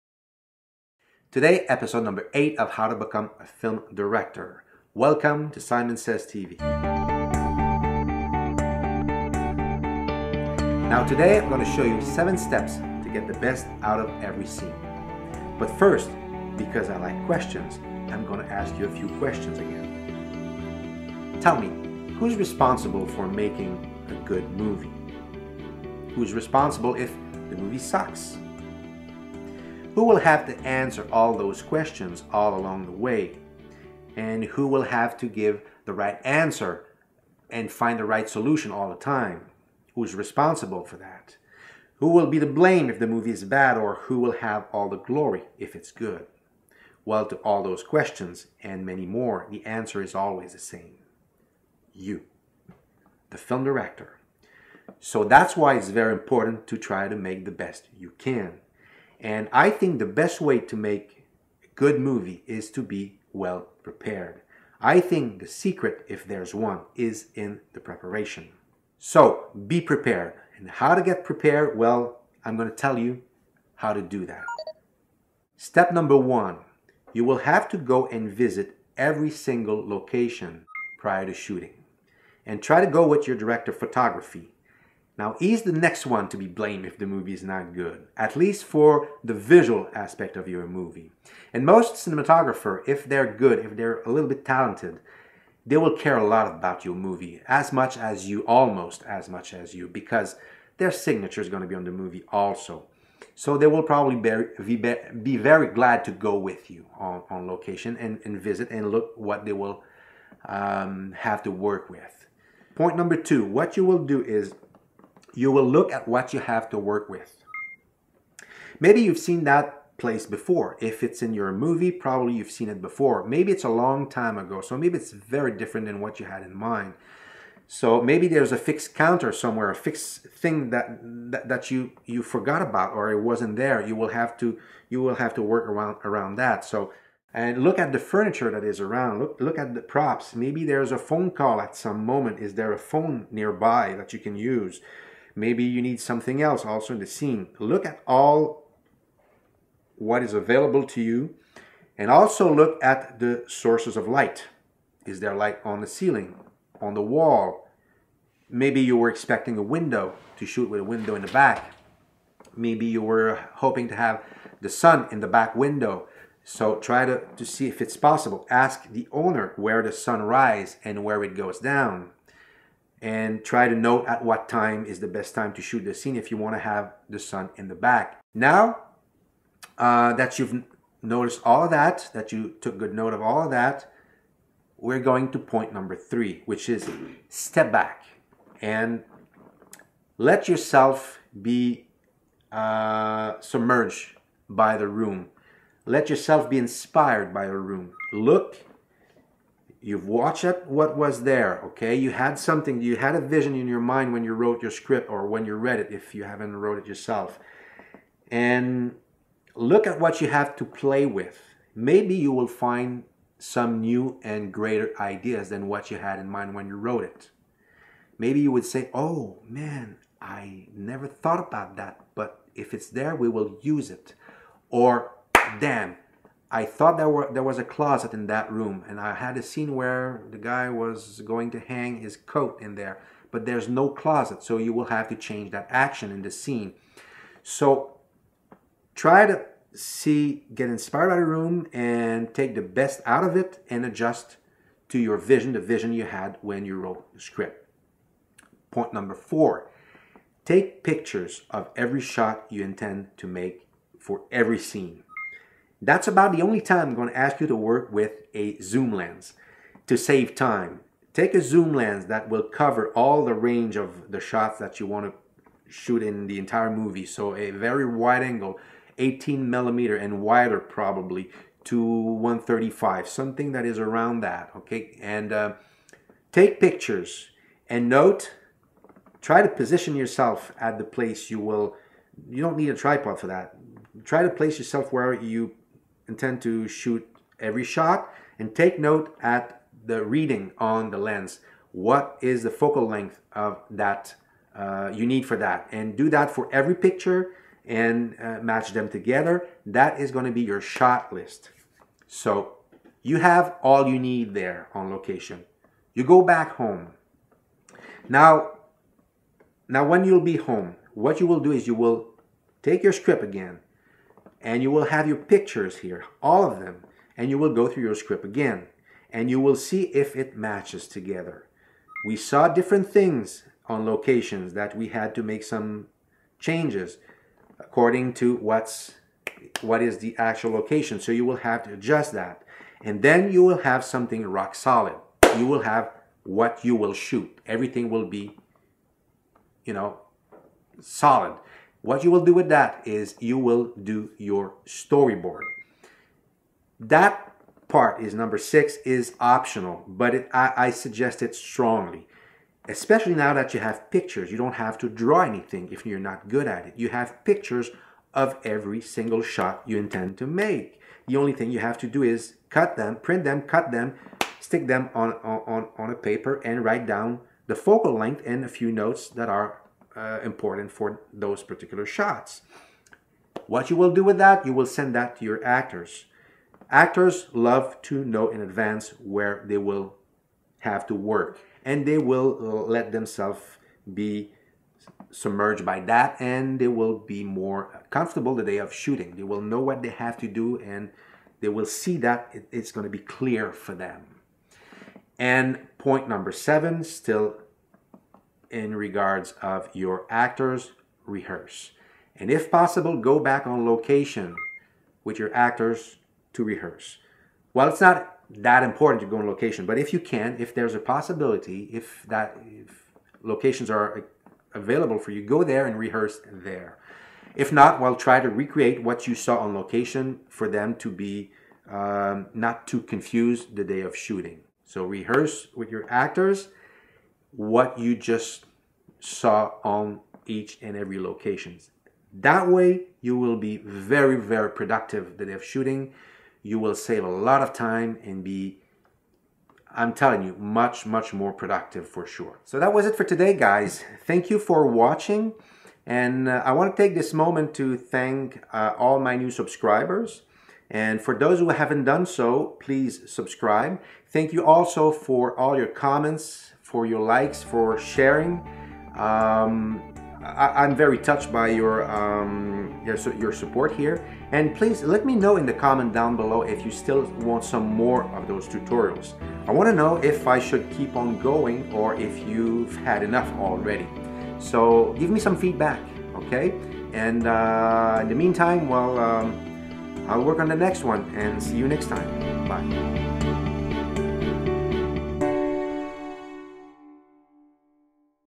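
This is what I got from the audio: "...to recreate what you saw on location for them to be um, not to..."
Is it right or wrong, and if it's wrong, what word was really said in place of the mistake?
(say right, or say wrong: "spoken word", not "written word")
right.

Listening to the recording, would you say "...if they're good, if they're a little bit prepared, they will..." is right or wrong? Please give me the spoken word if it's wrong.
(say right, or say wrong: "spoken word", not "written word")
wrong: "talented", not "prepared".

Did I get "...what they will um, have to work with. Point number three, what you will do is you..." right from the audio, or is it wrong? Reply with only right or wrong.
wrong.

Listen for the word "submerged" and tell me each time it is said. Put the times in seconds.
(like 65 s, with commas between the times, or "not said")
193 s, 385 s.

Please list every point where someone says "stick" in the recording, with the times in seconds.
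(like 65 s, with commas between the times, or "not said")
364 s.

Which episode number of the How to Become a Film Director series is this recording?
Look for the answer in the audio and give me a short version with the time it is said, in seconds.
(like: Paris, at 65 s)
8, at 1 s.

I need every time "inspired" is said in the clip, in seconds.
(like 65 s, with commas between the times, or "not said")
196 s, 240 s.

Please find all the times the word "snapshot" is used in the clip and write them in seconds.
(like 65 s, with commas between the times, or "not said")
not said.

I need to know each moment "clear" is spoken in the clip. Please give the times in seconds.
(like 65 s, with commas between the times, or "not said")
392 s.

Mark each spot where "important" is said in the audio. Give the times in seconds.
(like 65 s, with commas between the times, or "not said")
56 s, 370 s, 408 s.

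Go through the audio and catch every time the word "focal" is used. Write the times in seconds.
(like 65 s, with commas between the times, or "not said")
292 s, 367 s.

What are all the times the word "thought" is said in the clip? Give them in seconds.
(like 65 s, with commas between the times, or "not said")
221 s, 226 s.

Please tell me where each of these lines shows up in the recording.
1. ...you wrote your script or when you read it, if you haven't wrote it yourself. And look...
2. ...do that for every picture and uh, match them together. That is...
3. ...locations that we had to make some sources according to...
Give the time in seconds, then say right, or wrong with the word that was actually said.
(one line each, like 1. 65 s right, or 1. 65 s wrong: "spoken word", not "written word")
1. 204 s right
2. 296 s right
3. 323 s wrong: "changes", not "sources".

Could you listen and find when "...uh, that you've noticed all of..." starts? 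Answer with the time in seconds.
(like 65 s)
179 s.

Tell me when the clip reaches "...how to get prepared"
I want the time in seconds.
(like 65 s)
70 s.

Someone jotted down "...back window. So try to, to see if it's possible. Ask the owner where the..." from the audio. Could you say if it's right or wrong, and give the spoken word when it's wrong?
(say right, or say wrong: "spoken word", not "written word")
right.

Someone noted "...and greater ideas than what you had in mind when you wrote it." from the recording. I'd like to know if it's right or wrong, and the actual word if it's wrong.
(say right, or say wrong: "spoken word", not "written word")
right.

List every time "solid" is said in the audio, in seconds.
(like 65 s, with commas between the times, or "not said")
334 s, 340 s.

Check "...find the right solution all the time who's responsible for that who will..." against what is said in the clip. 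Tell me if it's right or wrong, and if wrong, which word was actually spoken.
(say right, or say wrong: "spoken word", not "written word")
right.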